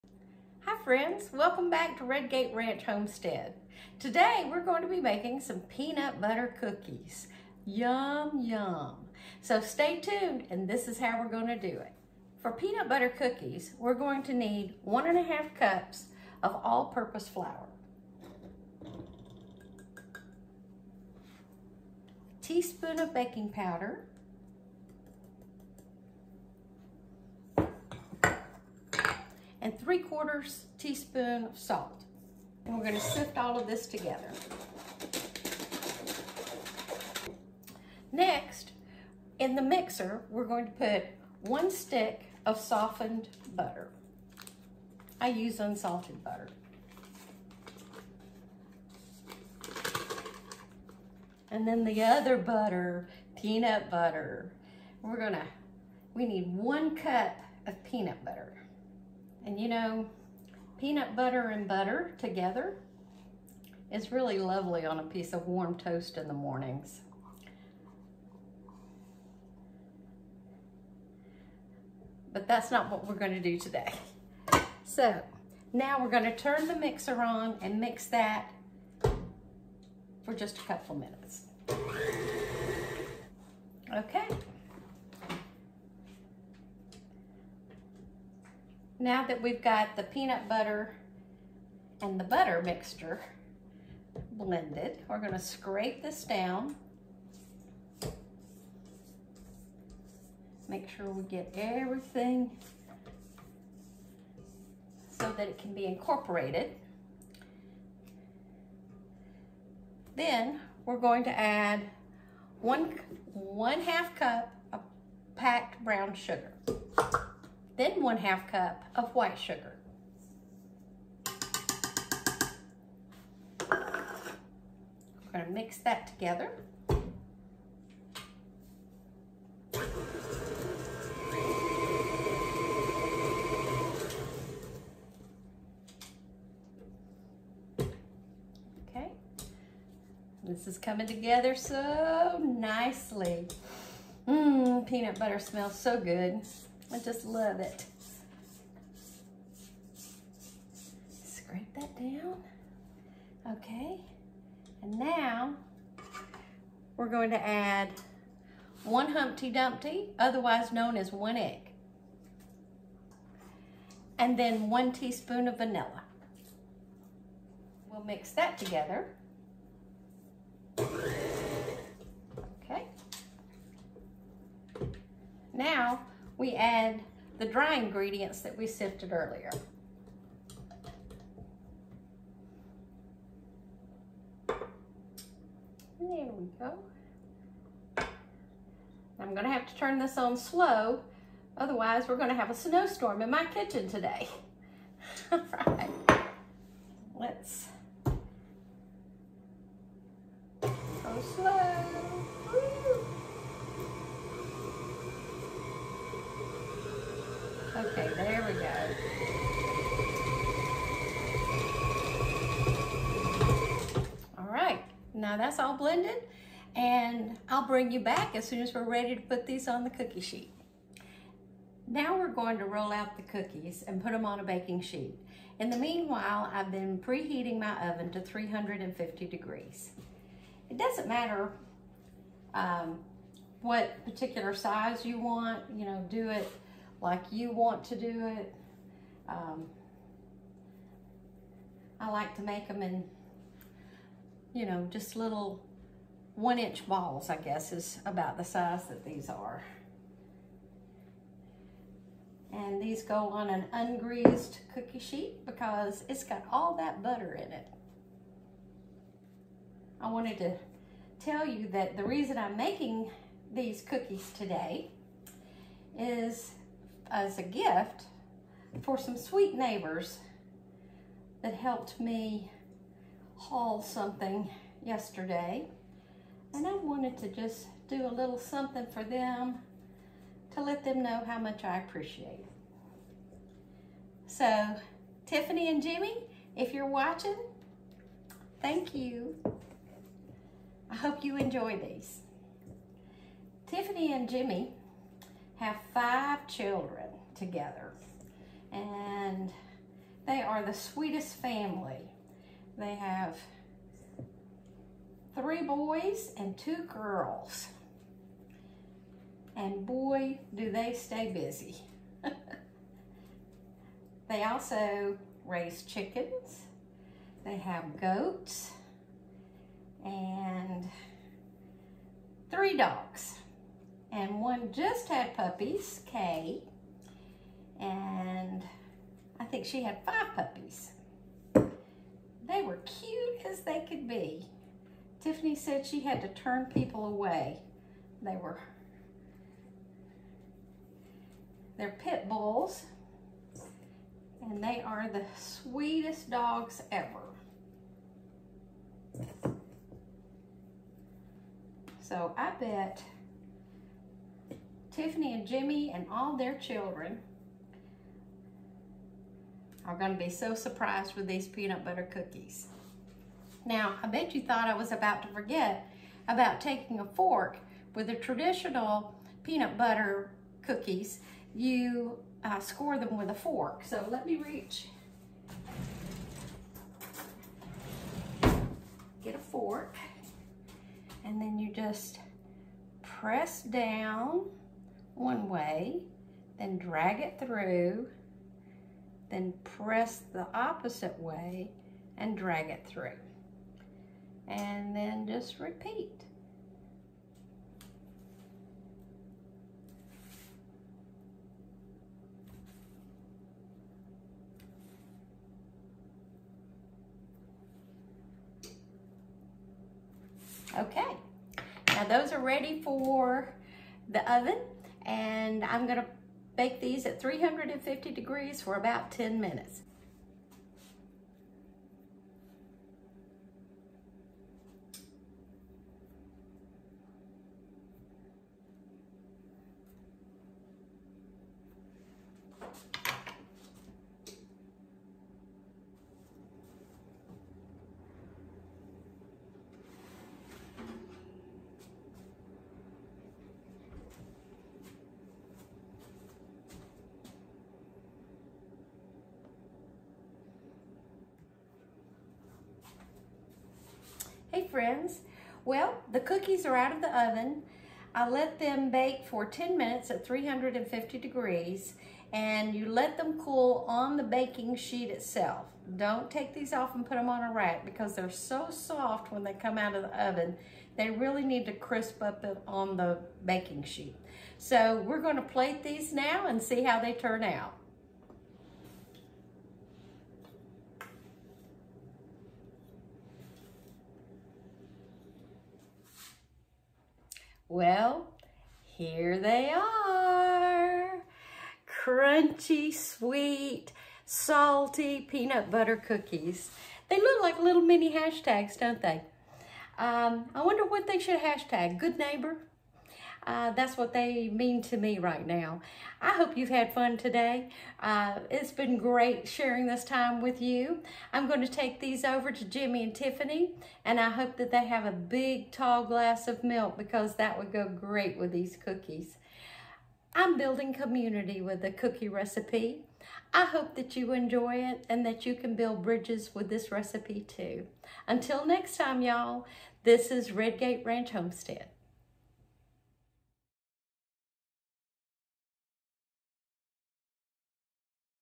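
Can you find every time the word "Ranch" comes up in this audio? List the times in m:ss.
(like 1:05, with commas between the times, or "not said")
0:02, 8:51.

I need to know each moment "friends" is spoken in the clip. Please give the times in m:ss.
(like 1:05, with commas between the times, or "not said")
0:00, 7:34.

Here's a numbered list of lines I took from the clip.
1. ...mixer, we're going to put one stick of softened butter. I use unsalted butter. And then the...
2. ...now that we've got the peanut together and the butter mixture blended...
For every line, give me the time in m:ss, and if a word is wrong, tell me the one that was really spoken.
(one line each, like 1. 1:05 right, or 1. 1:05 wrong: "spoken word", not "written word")
1. 0:39 right
2. 1:29 wrong: "butter", not "together".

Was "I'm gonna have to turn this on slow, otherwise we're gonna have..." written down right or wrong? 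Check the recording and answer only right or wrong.
right.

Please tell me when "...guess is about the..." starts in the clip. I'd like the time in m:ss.
4:07.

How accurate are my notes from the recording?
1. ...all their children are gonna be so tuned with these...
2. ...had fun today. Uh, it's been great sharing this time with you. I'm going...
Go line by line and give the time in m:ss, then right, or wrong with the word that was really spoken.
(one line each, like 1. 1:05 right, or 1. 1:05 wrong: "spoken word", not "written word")
1. 5:56 wrong: "surprised", not "tuned"
2. 8:26 right.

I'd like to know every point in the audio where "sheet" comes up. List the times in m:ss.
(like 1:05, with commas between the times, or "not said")
3:40, 3:44, 4:14, 7:44, 7:53.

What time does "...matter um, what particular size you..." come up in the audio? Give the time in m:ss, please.
3:51.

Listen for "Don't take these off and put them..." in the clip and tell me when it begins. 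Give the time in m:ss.
7:45.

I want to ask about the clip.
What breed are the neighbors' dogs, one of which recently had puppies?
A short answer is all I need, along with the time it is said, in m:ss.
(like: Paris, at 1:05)
Pit bulls, at 5:41.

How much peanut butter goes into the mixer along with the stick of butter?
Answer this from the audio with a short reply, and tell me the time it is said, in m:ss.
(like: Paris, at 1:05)
1 cup, at 0:56.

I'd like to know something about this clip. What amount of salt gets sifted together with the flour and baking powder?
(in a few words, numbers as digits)
3/4 teaspoon.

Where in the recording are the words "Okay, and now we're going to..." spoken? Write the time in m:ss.
2:33.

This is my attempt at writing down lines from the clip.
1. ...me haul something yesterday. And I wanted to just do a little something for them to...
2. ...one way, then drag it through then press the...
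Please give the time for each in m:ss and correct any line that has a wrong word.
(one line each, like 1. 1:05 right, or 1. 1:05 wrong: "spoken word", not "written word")
1. 4:31 right
2. 6:25 right.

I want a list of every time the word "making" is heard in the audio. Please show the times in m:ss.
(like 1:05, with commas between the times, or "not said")
0:04, 4:22.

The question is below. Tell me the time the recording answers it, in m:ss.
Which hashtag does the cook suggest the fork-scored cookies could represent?
8:21.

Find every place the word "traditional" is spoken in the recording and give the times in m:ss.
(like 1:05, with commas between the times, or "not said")
6:08.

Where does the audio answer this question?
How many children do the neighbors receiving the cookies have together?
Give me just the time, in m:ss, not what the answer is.
4:55.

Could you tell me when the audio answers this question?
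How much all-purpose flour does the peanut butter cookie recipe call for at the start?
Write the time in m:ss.
0:14.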